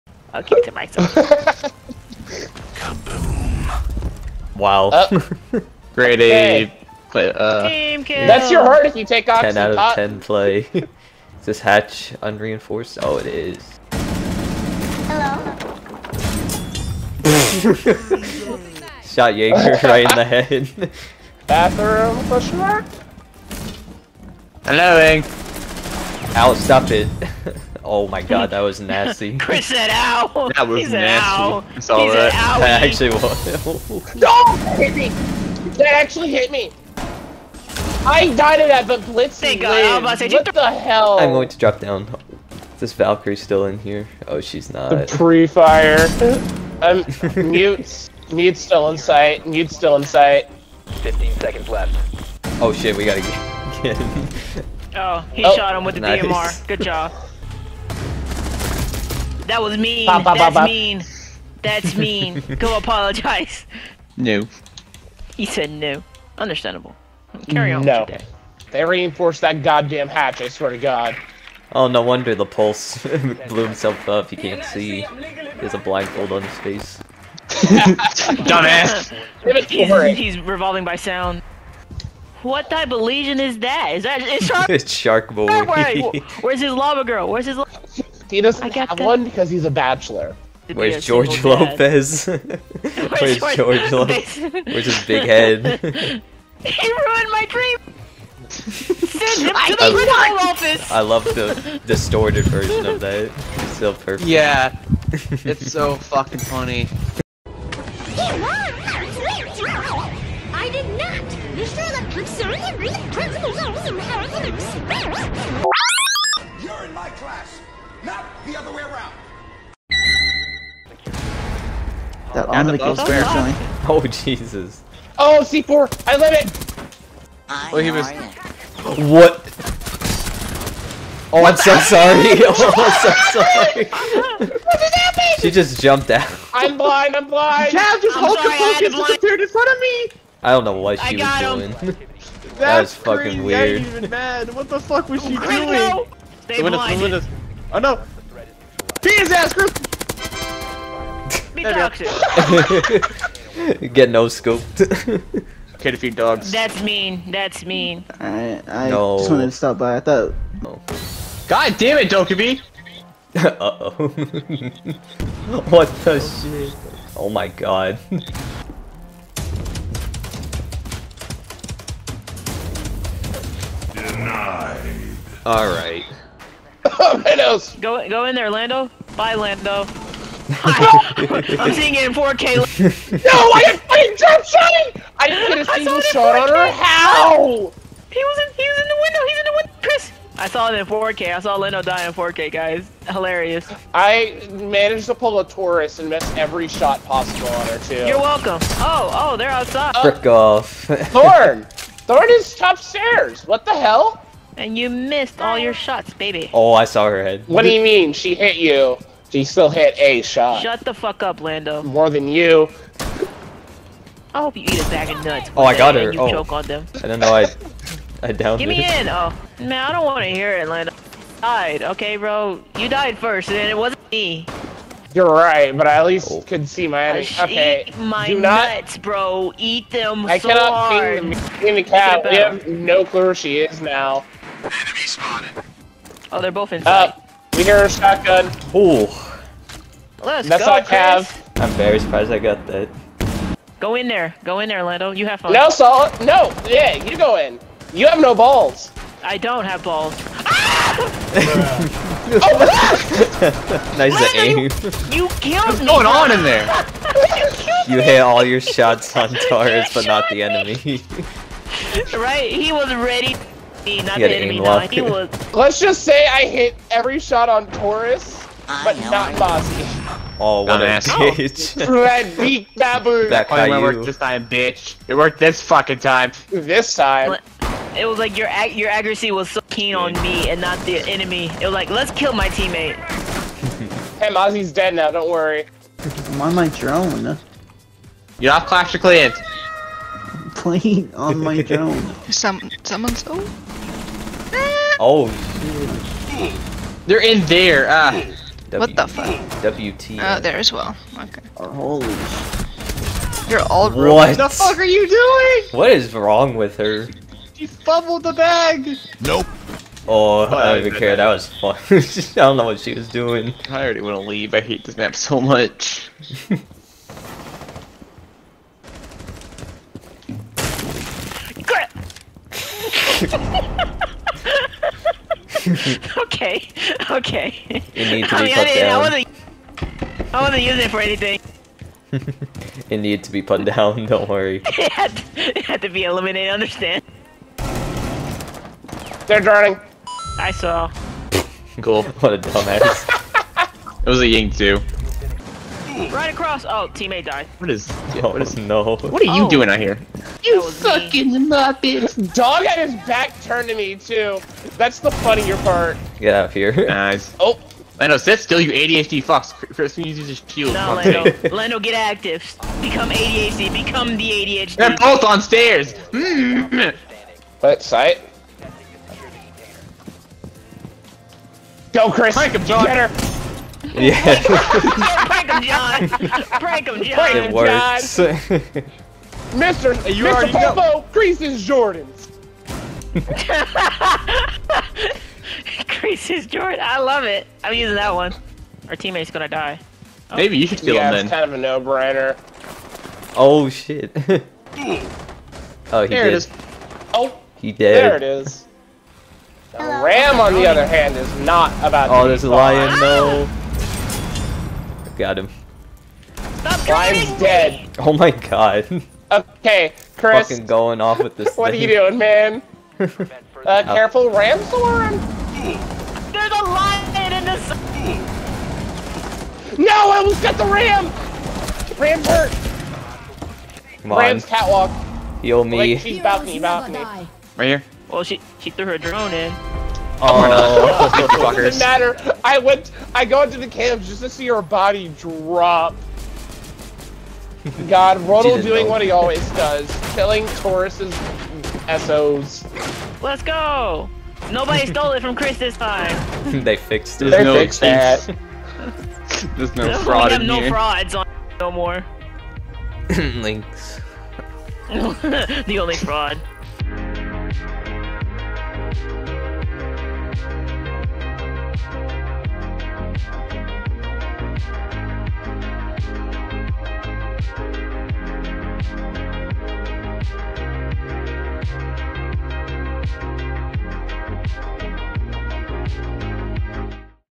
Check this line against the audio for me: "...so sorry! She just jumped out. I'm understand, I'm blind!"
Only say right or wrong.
wrong.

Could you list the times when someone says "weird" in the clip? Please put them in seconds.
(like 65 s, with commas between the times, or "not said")
143 s.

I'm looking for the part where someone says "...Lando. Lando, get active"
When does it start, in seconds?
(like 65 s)
360 s.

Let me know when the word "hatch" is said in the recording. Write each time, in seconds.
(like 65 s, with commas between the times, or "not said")
11 s, 70 s.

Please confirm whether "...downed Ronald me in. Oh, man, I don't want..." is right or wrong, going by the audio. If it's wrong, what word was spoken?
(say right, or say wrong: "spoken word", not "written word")
wrong: "Give", not "Ronald".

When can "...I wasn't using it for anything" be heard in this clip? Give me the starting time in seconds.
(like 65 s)
330 s.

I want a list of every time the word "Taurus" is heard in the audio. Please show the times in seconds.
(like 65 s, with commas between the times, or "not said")
195 s, 259 s, 267 s, 440 s.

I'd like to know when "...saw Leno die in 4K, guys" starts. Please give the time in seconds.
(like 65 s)
191 s.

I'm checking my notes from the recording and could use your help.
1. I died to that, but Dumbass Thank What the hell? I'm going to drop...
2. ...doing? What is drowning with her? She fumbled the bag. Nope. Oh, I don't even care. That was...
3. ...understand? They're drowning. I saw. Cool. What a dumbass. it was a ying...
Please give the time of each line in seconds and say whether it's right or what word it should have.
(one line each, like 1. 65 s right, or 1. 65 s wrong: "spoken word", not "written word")
1. 38 s wrong: "Blitz", not "Dumbass"
2. 305 s wrong: "wrong", not "drowning"
3. 336 s right.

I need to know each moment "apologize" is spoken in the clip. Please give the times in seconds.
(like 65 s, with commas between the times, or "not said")
62 s.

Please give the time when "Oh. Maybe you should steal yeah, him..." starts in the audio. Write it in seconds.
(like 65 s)
390 s.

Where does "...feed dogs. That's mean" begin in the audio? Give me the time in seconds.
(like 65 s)
155 s.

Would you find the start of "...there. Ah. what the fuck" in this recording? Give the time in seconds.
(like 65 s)
297 s.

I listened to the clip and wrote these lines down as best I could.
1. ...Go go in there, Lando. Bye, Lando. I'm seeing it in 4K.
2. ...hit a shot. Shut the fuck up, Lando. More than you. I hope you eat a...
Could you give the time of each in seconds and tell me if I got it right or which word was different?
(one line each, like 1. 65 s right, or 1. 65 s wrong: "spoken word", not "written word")
1. 177 s right
2. 209 s right.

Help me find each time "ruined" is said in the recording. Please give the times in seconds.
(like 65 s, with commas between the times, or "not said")
96 s, 303 s.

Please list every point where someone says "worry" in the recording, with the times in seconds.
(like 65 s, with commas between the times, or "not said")
285 s, 334 s.